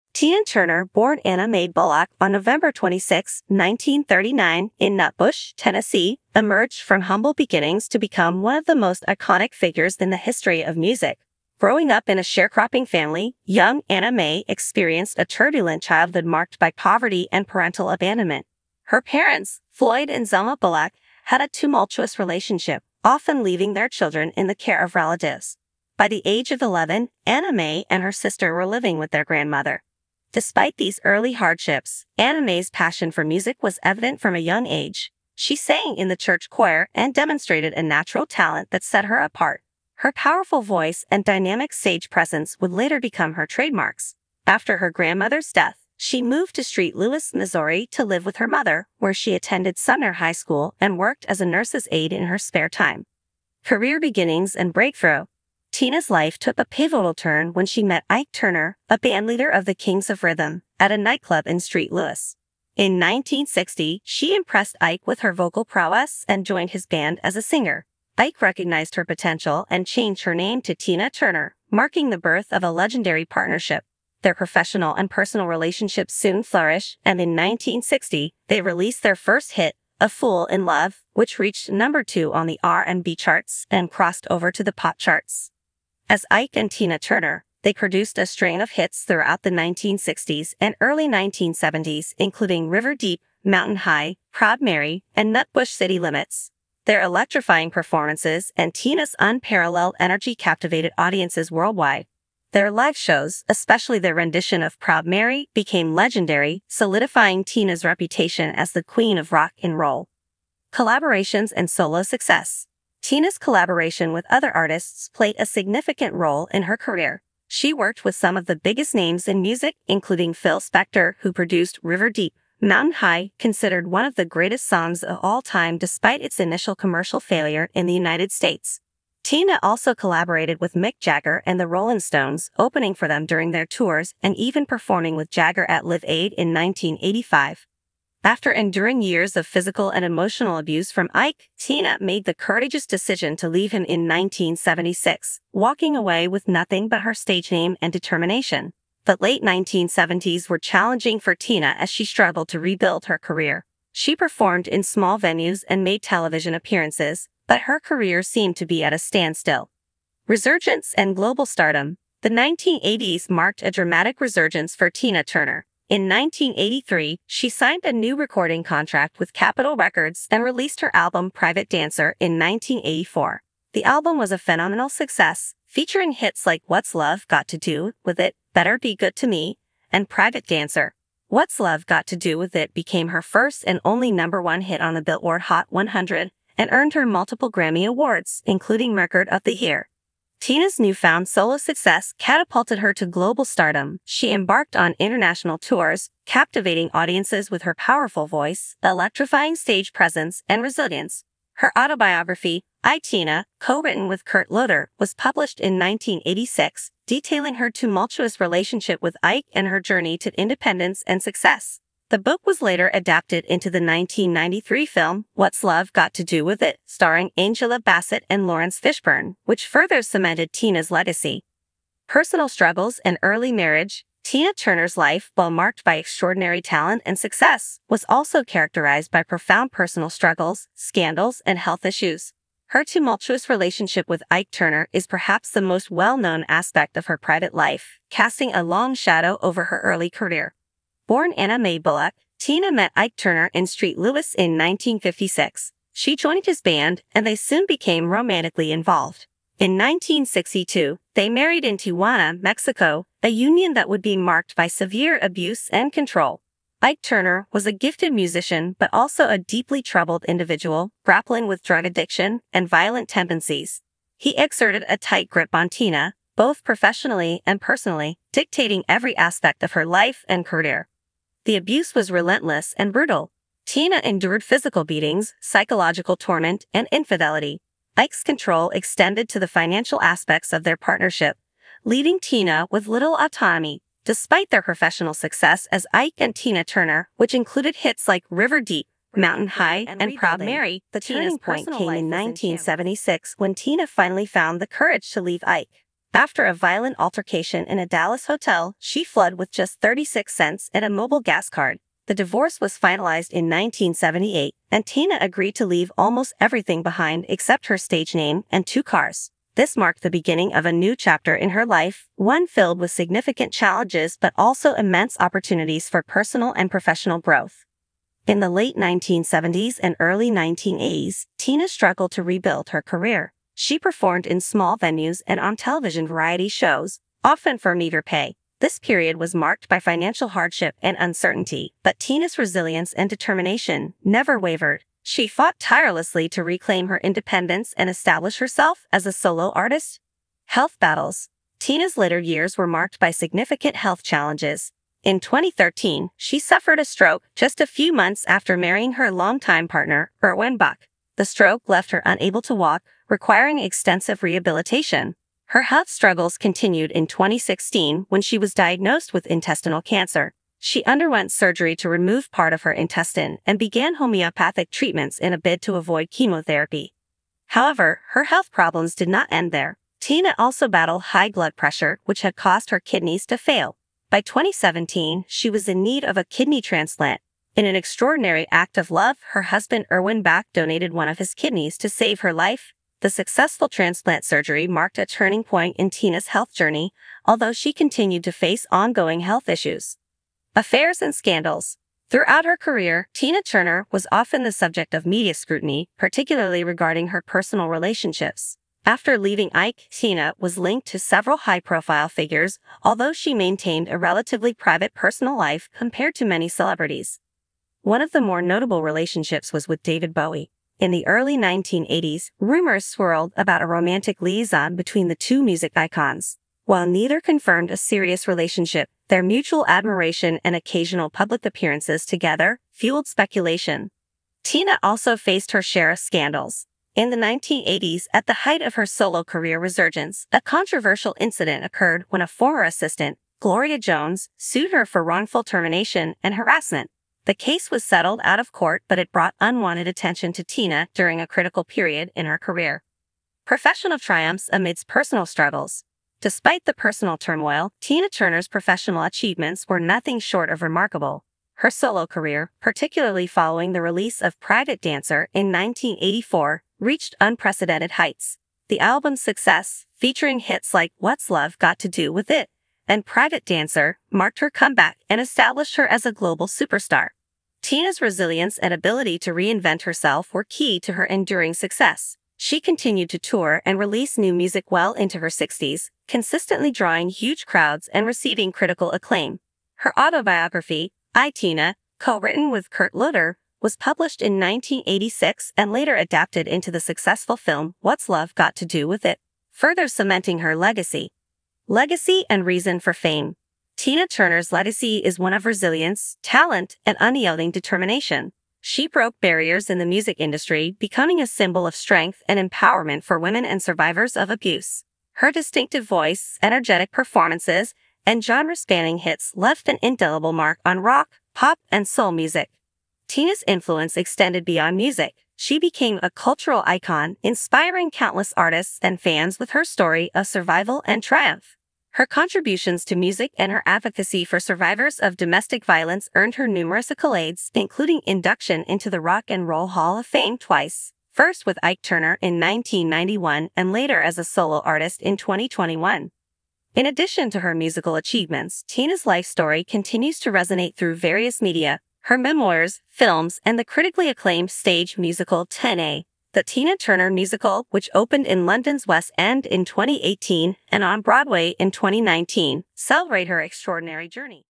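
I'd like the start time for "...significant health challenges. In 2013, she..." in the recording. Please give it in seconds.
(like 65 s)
343 s.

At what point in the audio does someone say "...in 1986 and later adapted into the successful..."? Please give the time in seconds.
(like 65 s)
484 s.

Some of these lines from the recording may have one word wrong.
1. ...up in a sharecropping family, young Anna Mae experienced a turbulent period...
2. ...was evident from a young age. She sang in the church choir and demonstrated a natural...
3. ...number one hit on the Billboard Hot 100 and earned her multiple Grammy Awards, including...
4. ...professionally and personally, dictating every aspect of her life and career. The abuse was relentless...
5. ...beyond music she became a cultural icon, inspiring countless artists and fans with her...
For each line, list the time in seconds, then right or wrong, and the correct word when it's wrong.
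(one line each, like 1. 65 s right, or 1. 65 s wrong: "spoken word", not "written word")
1. 11 s wrong: "childhood", not "period"
2. 33 s right
3. 184 s right
4. 266 s right
5. 514 s right.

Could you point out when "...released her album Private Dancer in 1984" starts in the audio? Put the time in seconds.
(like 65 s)
170 s.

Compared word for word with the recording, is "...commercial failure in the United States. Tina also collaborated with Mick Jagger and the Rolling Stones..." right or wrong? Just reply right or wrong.
right.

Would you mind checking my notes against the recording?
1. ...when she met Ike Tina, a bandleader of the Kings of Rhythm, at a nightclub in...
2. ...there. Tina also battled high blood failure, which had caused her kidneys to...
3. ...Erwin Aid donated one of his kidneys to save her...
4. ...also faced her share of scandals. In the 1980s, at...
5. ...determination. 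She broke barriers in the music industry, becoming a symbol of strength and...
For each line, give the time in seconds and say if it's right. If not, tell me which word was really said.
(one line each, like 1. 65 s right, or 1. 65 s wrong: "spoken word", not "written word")
1. 57 s wrong: "Turner", not "Tina"
2. 369 s wrong: "pressure", not "failure"
3. 379 s wrong: "Bach", not "Aid"
4. 424 s right
5. 497 s right.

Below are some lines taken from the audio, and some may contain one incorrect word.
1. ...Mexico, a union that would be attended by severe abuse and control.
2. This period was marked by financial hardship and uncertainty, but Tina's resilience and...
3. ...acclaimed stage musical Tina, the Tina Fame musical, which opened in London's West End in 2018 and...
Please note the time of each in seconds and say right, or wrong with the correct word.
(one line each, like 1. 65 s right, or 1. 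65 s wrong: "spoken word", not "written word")
1. 252 s wrong: "marked", not "attended"
2. 328 s right
3. 544 s wrong: "Turner", not "Fame".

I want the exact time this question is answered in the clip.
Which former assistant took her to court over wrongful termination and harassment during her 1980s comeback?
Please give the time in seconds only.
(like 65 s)
433 s.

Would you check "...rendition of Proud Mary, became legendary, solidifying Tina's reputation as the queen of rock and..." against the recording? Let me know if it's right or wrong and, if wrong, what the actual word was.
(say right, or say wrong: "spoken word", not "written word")
right.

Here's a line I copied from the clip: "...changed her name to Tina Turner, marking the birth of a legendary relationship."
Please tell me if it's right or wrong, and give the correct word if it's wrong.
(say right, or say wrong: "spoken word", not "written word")
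wrong: "partnership", not "relationship".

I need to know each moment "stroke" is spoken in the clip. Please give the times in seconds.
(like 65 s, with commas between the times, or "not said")
346 s, 351 s.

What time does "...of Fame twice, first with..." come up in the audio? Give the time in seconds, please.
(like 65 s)
529 s.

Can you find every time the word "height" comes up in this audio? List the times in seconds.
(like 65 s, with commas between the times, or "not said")
428 s, 457 s.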